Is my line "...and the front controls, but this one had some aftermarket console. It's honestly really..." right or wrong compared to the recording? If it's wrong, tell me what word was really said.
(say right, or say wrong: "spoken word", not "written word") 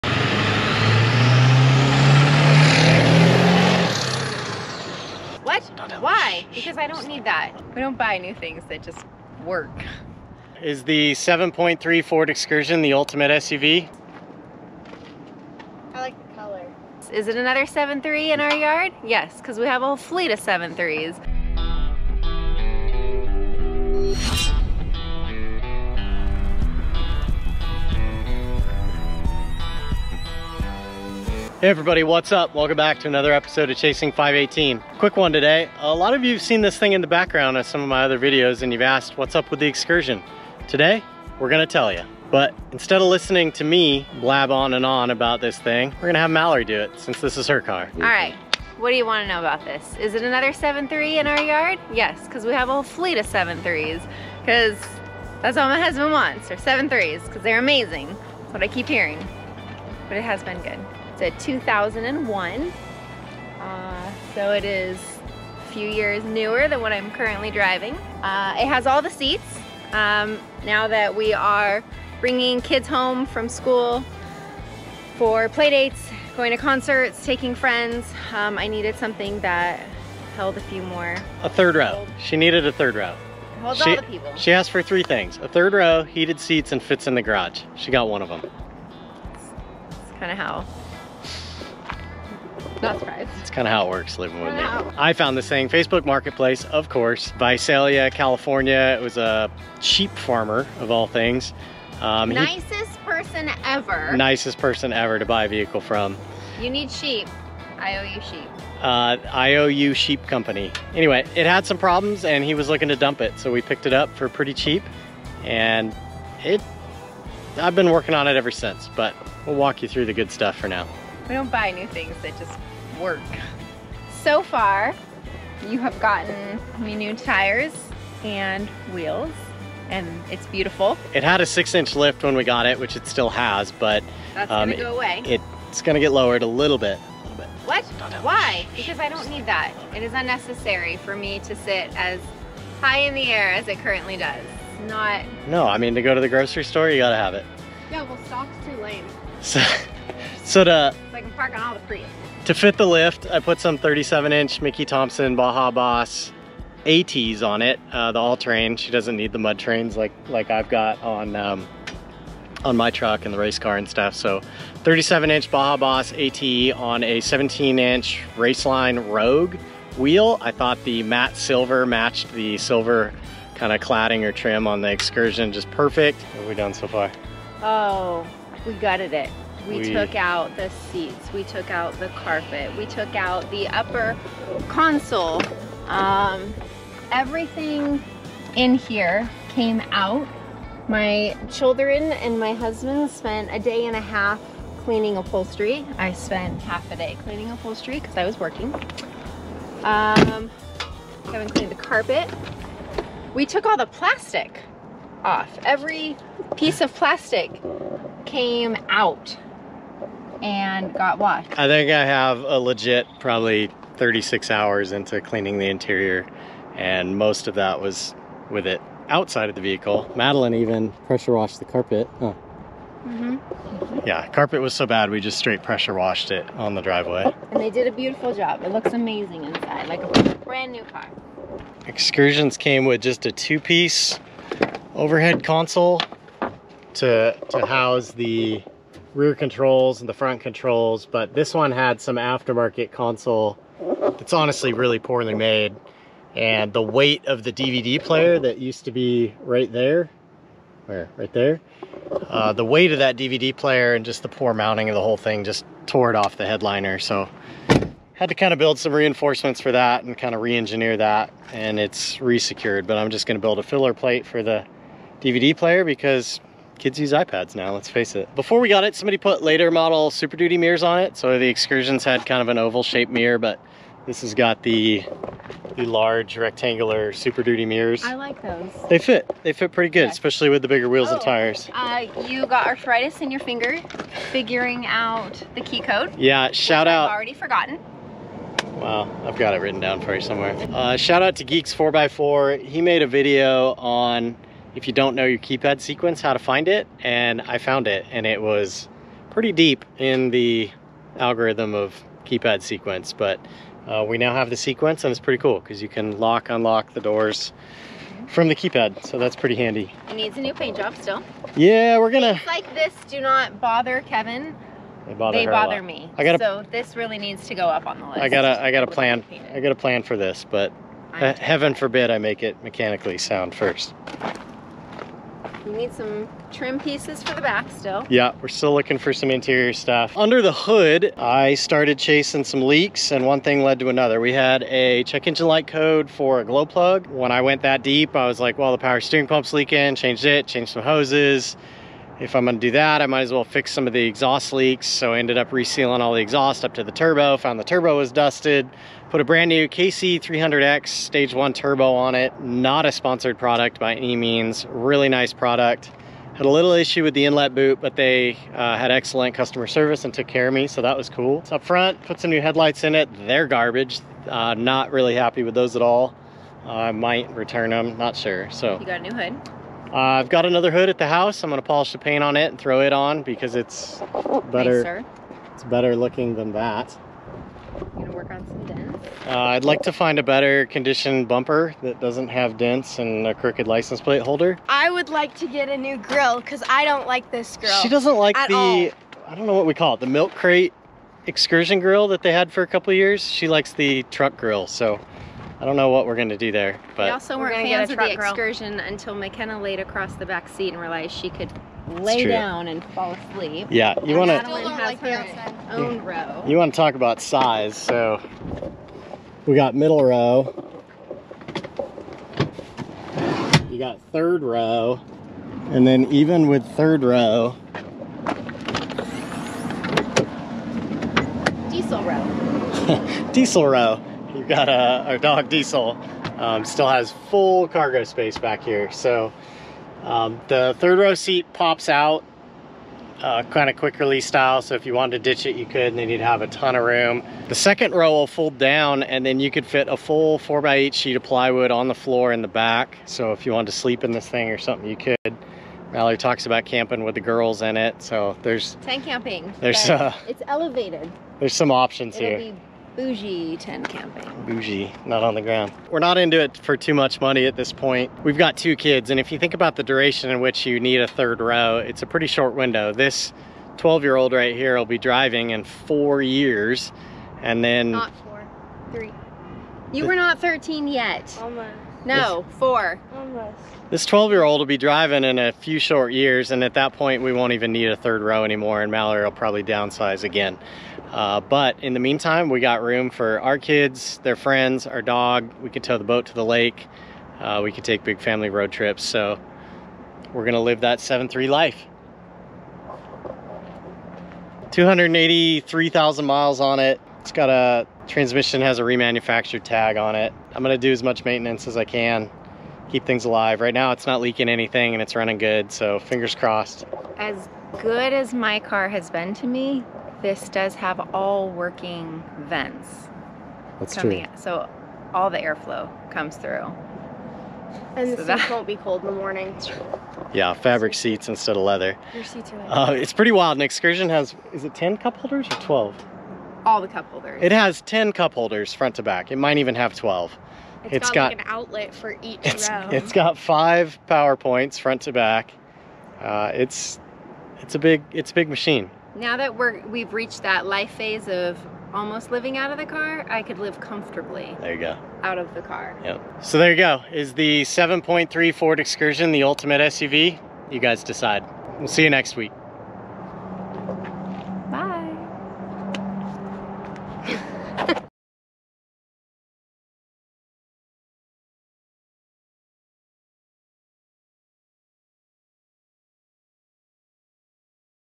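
right.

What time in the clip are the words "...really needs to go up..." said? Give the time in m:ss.
5:16.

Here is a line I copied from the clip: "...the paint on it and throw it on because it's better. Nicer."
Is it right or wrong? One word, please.
right.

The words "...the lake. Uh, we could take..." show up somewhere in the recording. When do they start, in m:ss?
8:06.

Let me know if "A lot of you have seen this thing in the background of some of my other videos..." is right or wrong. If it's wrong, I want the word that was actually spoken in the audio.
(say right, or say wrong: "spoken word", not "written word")
right.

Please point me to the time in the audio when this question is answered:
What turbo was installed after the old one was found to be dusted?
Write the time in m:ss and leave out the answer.
5:49.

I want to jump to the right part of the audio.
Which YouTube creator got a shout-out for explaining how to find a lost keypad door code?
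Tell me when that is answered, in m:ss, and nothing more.
4:51.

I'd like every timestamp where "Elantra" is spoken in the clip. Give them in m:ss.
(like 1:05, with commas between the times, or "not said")
not said.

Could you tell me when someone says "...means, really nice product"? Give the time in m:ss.
5:54.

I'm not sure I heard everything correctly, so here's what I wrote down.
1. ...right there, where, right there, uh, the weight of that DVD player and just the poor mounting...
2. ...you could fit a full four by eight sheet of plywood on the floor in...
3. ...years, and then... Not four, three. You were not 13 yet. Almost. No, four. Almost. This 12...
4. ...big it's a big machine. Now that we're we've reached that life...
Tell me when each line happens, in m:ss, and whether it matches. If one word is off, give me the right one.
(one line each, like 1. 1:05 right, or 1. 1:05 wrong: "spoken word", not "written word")
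1. 4:09 right
2. 7:19 right
3. 7:46 right
4. 8:57 right.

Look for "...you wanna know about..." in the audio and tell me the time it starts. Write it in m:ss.
0:48.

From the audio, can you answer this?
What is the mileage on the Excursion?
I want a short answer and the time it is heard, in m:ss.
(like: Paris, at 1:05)
283,000, at 8:14.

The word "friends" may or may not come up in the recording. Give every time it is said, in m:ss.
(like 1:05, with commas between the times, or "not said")
1:17, 8:04.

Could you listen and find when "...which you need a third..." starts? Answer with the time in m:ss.
7:40.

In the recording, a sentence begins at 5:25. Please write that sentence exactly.
We need some trim pieces for the back still.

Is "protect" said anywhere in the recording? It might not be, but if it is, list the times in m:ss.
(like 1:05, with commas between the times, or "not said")
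not said.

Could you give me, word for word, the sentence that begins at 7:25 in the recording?
Mallory talks about camping with the girls in it.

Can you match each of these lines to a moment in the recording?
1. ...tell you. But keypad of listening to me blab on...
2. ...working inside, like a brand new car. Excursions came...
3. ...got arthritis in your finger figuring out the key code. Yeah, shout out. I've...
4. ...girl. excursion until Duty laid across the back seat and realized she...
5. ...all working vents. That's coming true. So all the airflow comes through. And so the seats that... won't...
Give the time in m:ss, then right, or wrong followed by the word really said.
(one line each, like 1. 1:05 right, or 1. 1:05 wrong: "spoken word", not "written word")
1. 0:41 wrong: "instead", not "keypad"
2. 3:48 wrong: "amazing", not "working"
3. 4:42 right
4. 6:38 wrong: "McKenna", not "Duty"
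5. 8:31 right.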